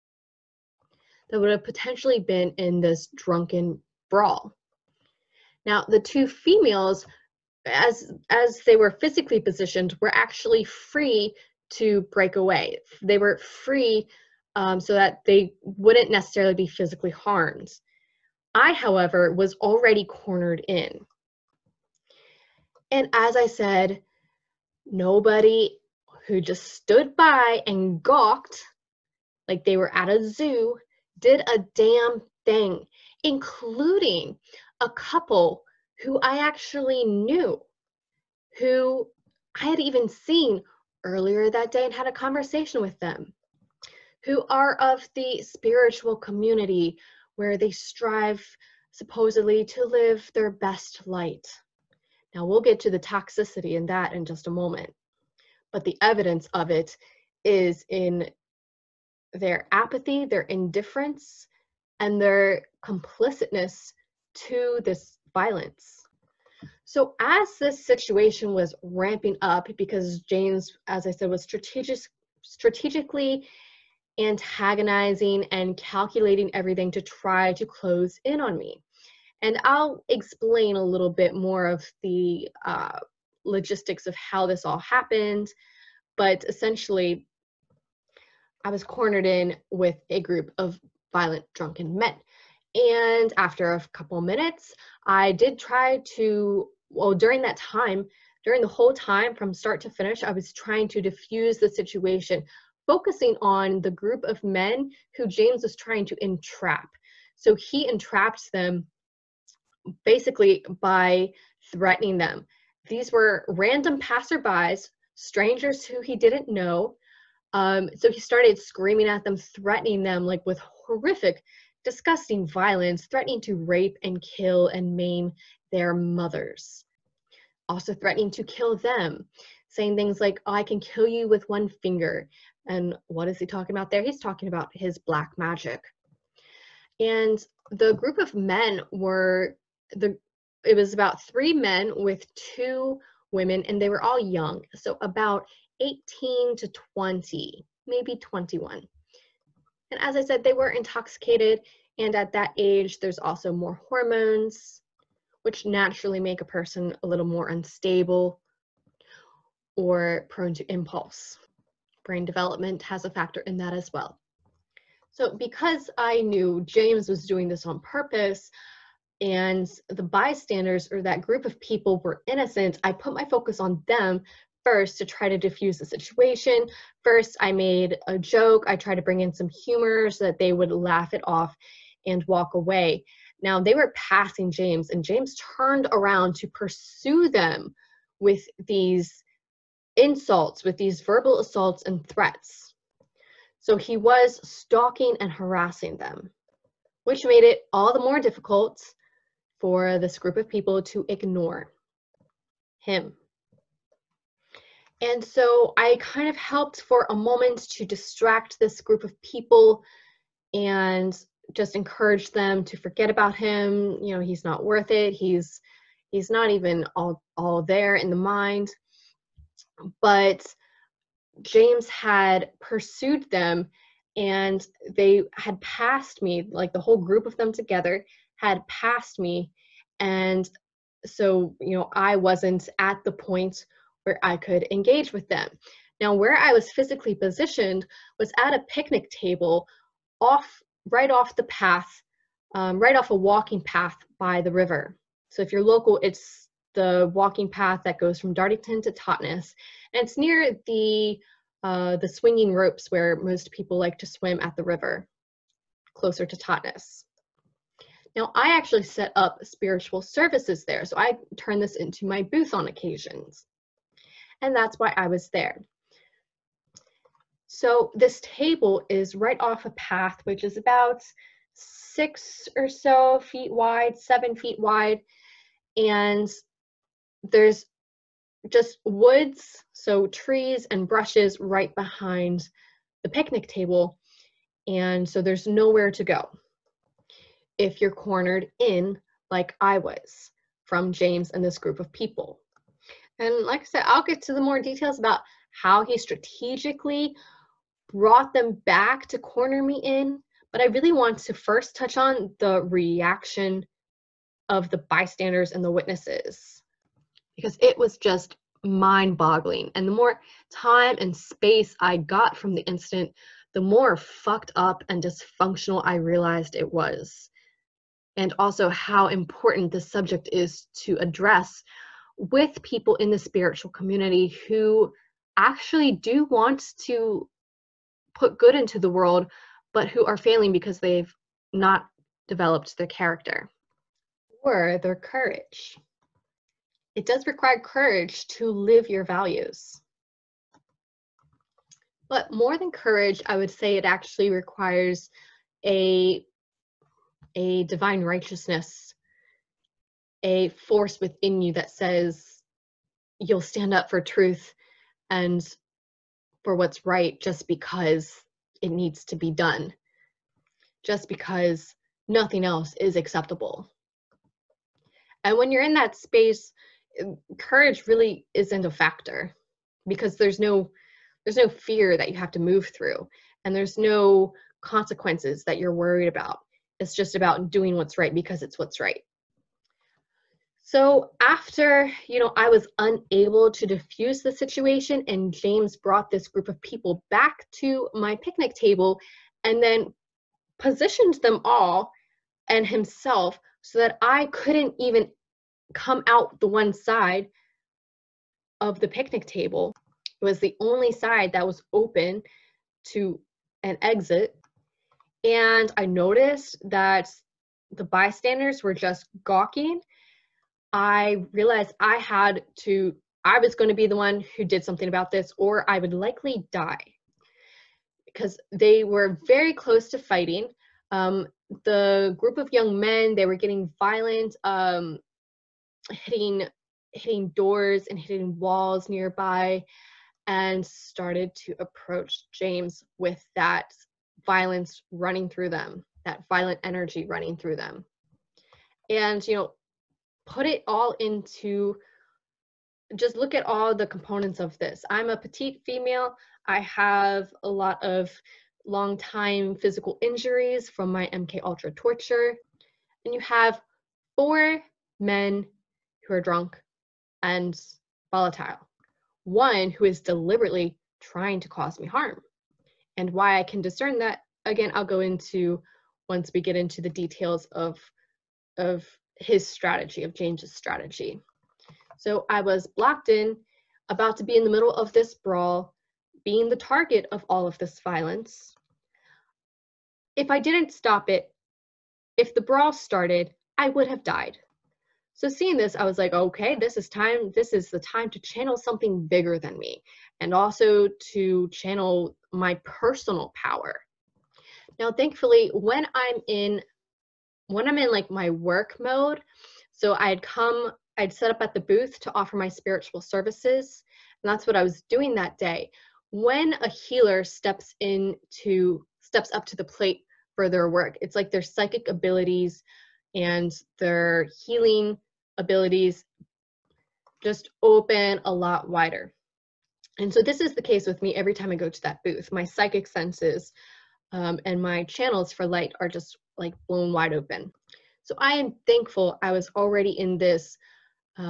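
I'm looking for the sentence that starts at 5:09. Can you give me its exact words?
And the more time and space I got from the incident, the more fucked up and dysfunctional I realized it was.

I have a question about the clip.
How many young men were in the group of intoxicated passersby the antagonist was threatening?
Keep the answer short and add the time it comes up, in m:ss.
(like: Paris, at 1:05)
3, at 2:21.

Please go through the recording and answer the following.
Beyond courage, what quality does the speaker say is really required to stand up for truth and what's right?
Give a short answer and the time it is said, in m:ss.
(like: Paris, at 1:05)
Divine righteousness, at 5:47.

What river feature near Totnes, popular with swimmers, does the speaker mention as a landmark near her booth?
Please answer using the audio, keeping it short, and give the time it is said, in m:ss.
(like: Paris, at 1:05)
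The swinging ropes, at 4:12.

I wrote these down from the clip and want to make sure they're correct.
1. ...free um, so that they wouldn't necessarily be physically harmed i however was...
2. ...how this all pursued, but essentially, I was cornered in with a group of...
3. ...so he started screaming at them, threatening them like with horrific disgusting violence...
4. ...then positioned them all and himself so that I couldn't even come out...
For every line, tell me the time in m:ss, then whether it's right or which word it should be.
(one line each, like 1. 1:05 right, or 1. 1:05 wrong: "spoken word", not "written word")
1. 0:13 right
2. 1:24 wrong: "happened", not "pursued"
3. 1:57 right
4. 6:29 right.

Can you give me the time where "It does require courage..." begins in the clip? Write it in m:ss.
5:36.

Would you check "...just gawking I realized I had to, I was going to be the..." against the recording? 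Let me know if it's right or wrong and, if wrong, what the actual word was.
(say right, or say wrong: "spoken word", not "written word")
right.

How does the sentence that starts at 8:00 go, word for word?
If I didn't stop it, if the brawl started, I would have died.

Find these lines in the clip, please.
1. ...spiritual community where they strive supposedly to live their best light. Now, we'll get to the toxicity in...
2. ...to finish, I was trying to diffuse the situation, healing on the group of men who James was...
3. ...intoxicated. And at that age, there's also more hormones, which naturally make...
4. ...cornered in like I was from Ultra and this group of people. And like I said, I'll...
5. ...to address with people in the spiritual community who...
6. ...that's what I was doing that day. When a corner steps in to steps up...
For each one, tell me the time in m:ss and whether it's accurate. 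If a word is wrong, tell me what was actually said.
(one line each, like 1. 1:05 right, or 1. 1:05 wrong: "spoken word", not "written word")
1. 0:45 right
2. 1:39 wrong: "focusing", not "healing"
3. 2:30 right
4. 4:47 wrong: "James", not "Ultra"
5. 5:20 right
6. 8:24 wrong: "healer", not "corner".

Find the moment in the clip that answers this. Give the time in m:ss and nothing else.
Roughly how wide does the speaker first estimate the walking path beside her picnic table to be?
4:31.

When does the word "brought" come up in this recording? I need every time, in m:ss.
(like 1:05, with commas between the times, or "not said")
4:57, 6:25.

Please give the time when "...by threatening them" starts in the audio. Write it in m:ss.
1:50.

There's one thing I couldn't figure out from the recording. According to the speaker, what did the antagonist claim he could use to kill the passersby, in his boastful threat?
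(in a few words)
One finger.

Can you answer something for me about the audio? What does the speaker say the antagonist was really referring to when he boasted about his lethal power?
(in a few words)
Black magic.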